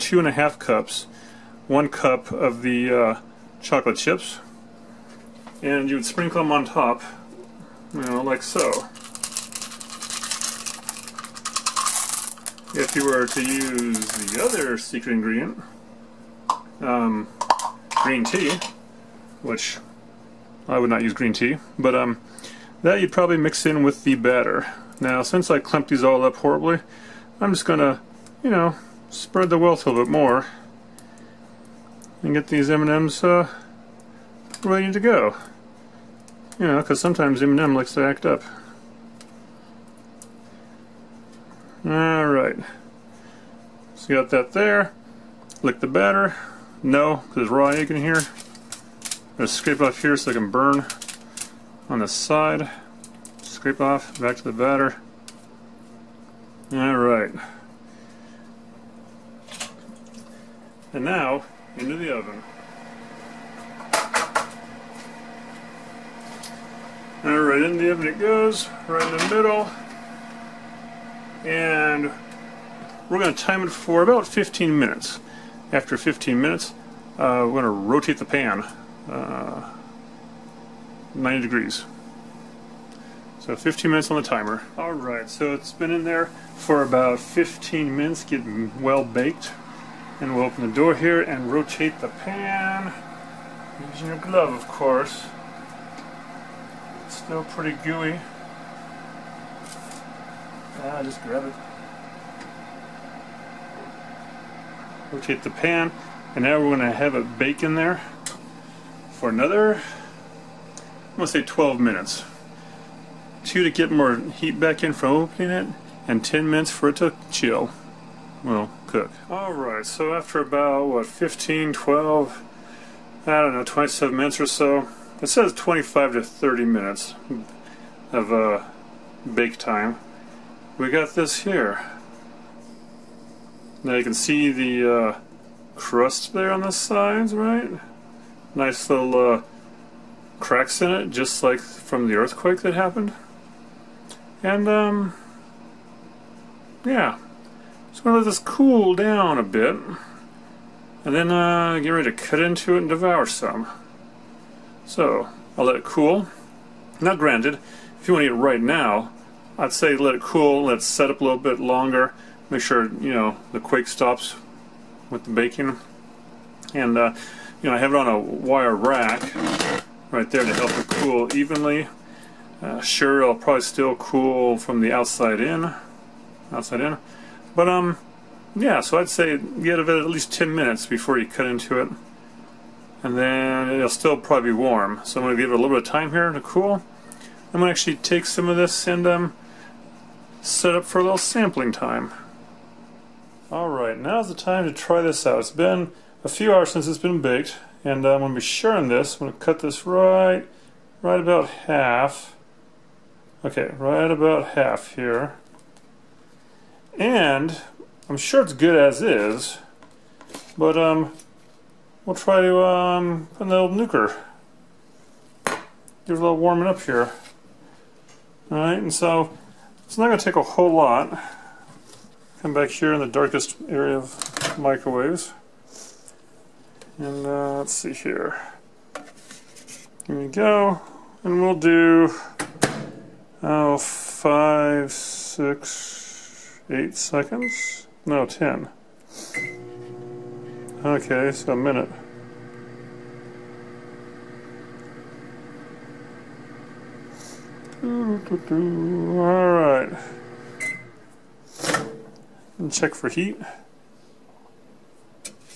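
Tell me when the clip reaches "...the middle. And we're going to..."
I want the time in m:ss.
1:09.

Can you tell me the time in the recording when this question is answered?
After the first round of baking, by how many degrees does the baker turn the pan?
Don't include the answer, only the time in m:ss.
1:21.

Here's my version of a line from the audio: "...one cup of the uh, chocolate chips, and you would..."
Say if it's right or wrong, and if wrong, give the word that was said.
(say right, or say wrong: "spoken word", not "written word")
right.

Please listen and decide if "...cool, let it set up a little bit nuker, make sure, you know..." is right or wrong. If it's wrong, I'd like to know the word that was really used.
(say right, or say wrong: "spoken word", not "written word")
wrong: "longer", not "nuker".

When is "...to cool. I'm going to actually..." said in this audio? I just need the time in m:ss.
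3:06.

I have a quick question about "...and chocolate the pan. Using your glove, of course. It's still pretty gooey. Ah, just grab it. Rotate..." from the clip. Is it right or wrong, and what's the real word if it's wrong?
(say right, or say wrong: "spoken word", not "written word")
wrong: "rotate", not "chocolate".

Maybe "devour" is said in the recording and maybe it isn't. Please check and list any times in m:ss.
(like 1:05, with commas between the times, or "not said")
2:32.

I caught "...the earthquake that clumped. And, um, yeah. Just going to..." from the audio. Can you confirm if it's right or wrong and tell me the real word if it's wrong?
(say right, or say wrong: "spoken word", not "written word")
wrong: "happened", not "clumped".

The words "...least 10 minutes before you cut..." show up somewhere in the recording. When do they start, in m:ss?
3:00.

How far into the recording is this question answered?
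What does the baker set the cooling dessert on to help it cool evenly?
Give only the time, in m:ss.
2:48.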